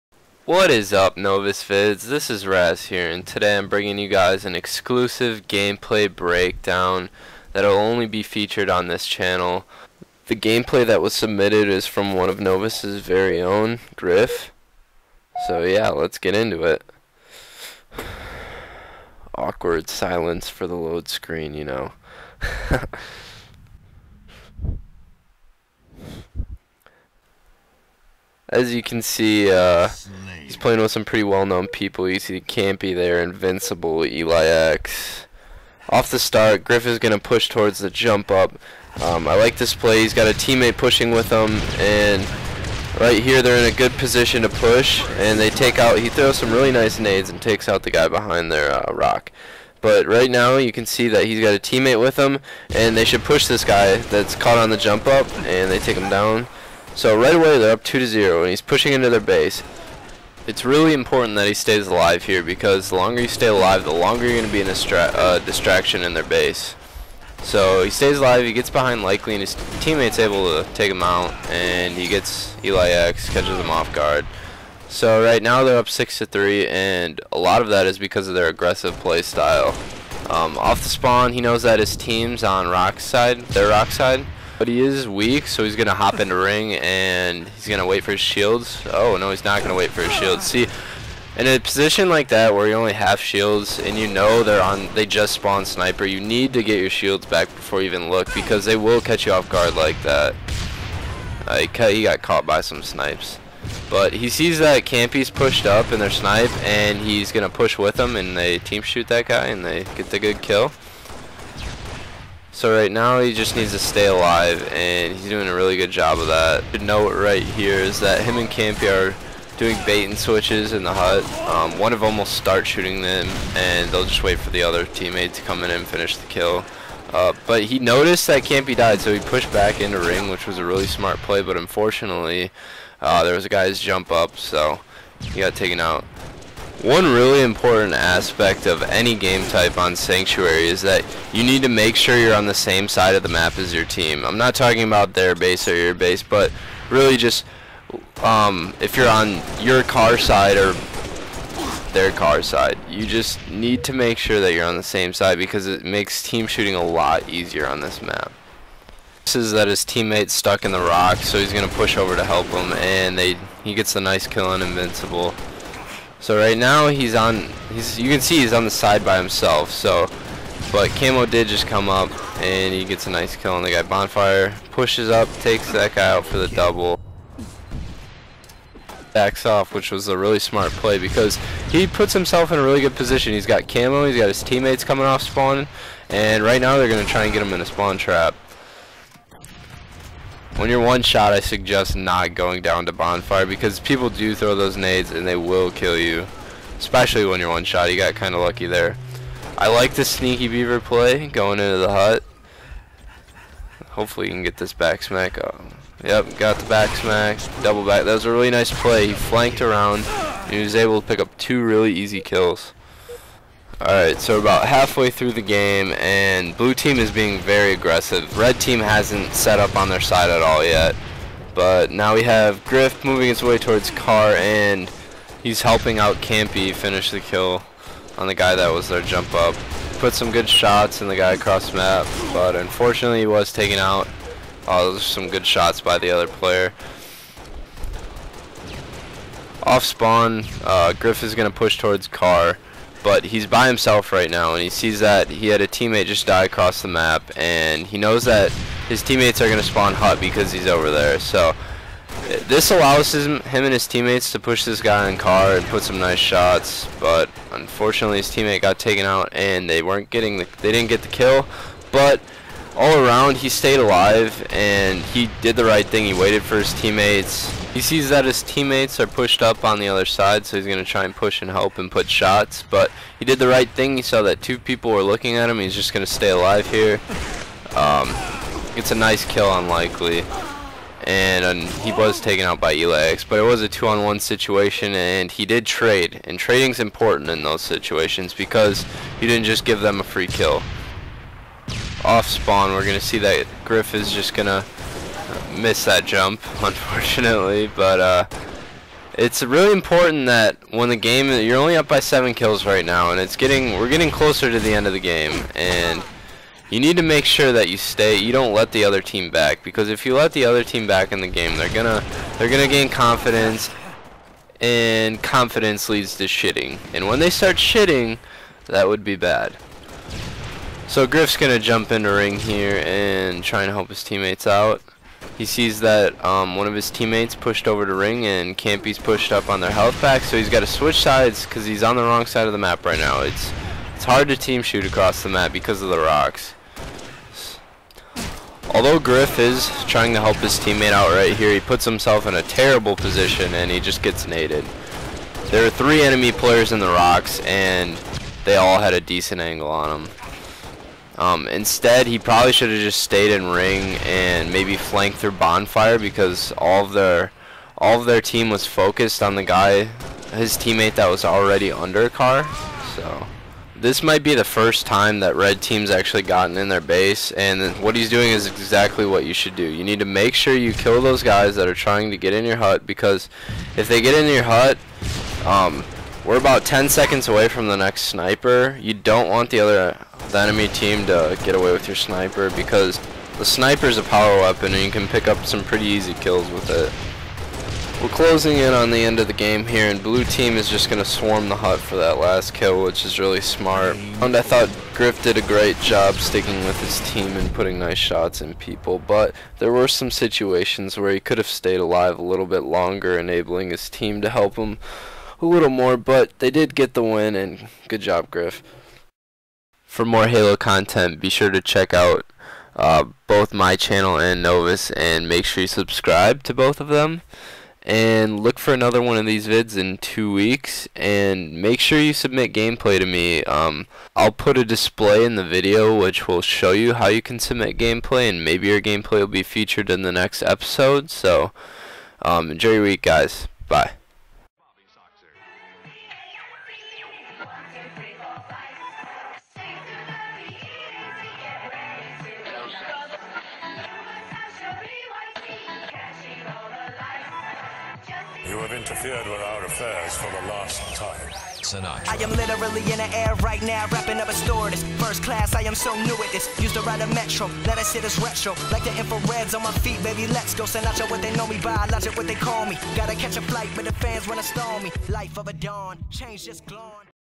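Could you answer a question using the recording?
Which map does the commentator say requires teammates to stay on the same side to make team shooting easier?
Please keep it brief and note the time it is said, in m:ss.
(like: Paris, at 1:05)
Sanctuary, at 2:19.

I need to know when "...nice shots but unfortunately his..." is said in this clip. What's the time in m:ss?
4:15.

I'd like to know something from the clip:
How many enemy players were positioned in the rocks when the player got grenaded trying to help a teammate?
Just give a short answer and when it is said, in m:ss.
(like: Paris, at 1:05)
3, at 5:45.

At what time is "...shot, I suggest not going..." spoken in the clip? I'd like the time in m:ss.
3:11.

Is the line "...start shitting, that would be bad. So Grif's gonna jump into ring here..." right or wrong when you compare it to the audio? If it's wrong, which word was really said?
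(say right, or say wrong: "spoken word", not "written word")
right.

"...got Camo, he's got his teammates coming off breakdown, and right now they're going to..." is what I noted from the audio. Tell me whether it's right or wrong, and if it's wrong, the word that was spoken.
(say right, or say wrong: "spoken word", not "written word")
wrong: "spawn", not "breakdown".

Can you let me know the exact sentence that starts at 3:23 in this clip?
Hopefully you can get this back smack.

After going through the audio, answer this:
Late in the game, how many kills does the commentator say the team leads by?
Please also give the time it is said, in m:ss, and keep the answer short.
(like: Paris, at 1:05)
7, at 5:01.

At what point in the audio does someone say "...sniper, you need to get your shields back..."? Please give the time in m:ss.
1:35.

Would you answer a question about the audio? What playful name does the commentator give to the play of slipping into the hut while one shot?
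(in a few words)
sneaky beaver.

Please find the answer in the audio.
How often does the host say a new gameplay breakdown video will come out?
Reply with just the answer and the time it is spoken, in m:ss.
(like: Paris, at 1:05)
two weeks, at 6:59.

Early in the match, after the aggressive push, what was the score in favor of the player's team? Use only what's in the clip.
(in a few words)
6 to 3.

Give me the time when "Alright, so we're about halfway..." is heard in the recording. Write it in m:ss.
3:33.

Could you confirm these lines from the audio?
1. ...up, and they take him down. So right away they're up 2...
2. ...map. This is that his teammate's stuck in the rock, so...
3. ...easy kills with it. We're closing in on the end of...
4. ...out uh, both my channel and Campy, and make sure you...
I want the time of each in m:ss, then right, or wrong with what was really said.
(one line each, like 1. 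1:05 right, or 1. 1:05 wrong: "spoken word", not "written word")
1. 0:55 right
2. 2:38 right
3. 6:25 right
4. 6:51 wrong: "Novus", not "Campy".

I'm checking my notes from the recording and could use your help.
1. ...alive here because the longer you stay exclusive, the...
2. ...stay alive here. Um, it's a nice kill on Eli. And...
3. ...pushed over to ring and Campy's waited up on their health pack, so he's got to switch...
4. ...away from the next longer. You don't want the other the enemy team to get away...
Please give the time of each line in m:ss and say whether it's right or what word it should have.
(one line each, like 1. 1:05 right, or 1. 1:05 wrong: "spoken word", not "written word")
1. 1:01 wrong: "alive", not "exclusive"
2. 4:36 wrong: "Likely", not "Eli"
3. 5:27 wrong: "pushed", not "waited"
4. 6:17 wrong: "sniper", not "longer".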